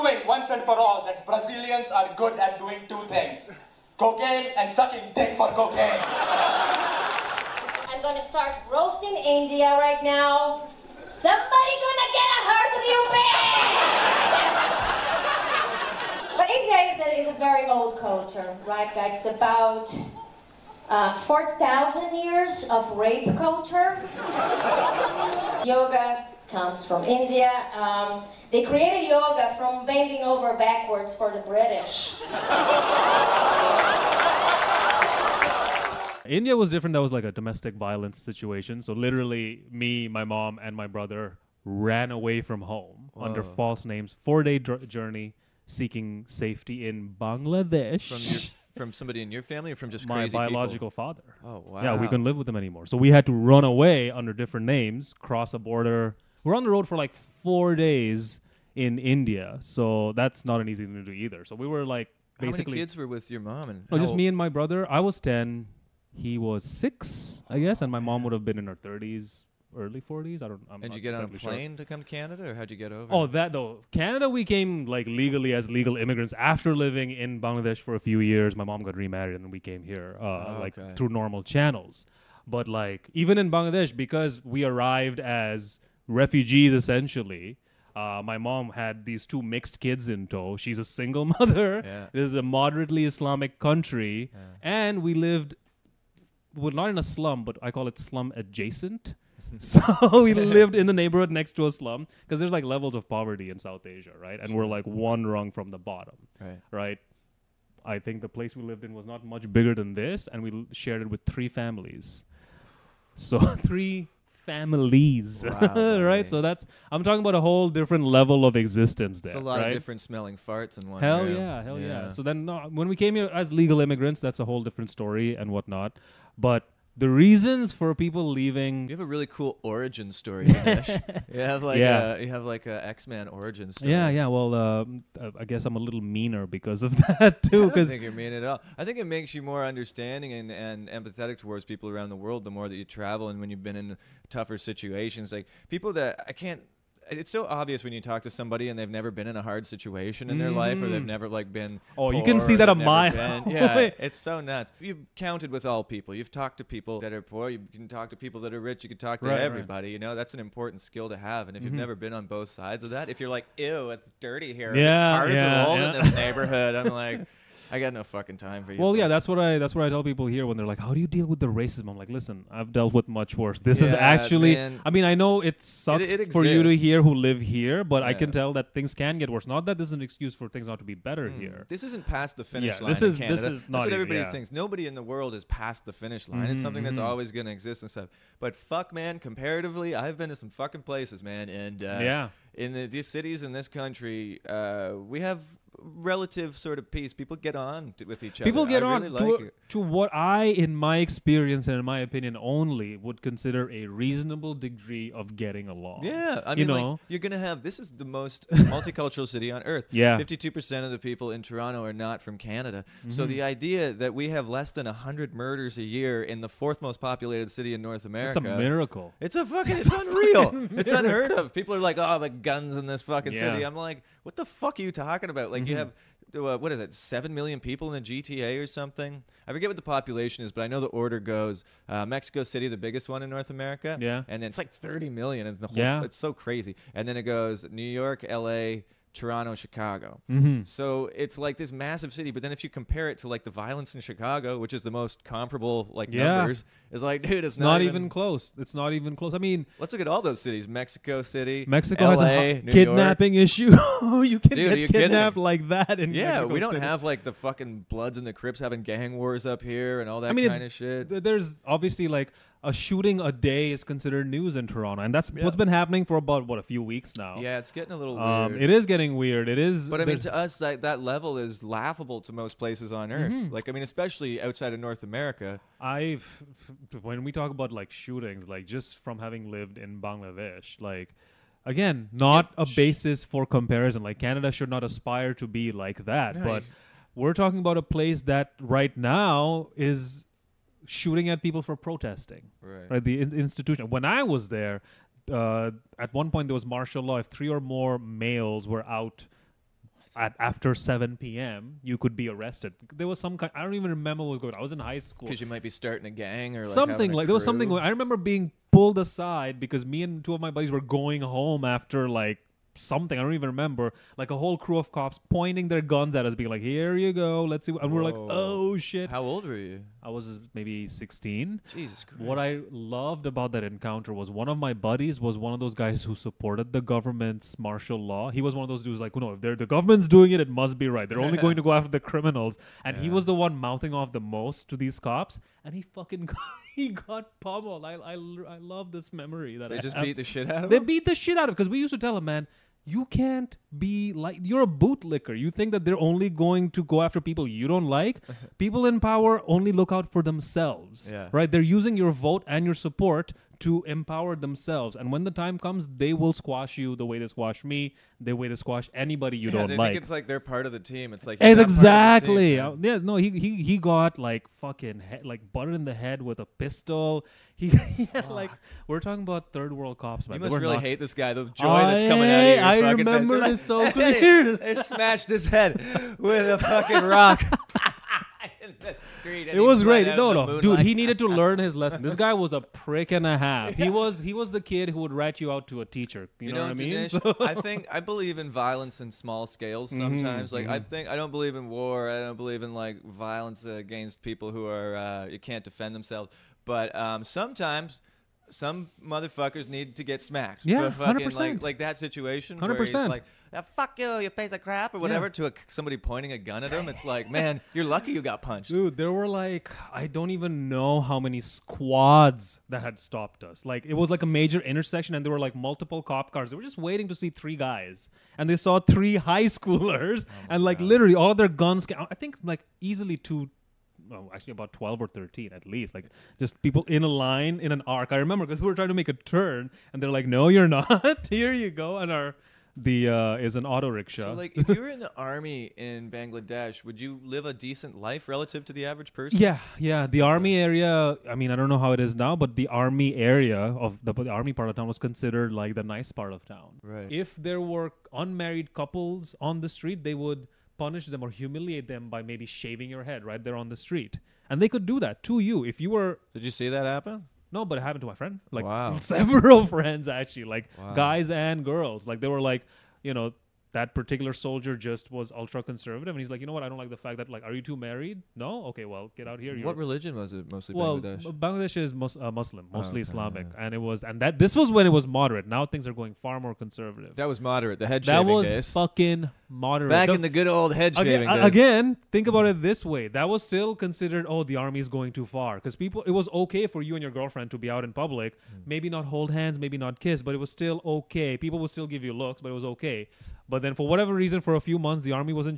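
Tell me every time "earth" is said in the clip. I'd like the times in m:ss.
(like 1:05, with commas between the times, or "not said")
3:29, 4:33.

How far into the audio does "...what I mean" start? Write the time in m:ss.
6:26.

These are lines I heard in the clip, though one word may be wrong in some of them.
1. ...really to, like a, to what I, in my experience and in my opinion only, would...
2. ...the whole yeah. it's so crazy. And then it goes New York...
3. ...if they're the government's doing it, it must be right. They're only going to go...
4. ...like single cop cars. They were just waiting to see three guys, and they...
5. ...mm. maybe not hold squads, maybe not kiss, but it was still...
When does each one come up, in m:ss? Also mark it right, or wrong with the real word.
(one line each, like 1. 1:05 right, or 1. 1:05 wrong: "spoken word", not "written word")
1. 3:19 right
2. 3:55 right
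3. 5:29 right
4. 6:55 wrong: "multiple", not "single"
5. 8:08 wrong: "hands", not "squads".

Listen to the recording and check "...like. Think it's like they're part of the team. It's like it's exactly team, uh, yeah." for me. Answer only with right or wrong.
right.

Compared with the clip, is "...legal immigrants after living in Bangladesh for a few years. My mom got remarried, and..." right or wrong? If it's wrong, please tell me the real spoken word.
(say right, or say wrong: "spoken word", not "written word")
right.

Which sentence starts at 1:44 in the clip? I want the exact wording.
And we're like one rung from the bottom, right?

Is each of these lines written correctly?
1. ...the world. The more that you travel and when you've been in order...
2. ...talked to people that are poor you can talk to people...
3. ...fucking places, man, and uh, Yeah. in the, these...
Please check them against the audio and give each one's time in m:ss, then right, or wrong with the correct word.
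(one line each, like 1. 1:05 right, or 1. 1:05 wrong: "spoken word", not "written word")
1. 2:22 wrong: "tougher", not "order"
2. 2:36 right
3. 3:10 right.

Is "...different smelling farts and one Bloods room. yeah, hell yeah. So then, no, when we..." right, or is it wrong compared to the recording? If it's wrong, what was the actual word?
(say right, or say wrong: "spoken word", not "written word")
wrong: "Hell", not "Bloods".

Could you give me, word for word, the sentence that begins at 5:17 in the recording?
we're like, "Oh shit!" How old were you?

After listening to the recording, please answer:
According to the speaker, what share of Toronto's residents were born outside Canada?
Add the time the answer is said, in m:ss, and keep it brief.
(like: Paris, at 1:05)
52 percent, at 3:30.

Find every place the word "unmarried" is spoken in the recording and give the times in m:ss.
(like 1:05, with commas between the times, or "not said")
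7:28.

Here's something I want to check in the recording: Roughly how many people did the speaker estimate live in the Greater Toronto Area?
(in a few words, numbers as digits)
7 million.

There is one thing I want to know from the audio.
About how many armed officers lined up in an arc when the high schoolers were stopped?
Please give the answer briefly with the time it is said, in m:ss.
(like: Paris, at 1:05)
12 or 13, at 7:04.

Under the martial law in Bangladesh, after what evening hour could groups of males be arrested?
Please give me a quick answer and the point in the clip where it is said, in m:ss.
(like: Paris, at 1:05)
7 p.m., at 5:00.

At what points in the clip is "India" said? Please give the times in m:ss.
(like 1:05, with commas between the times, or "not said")
0:09, 0:16, 0:27, 0:36, 0:58.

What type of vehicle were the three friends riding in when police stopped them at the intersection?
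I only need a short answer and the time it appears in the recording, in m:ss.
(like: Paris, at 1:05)
auto rickshaw, at 7:13.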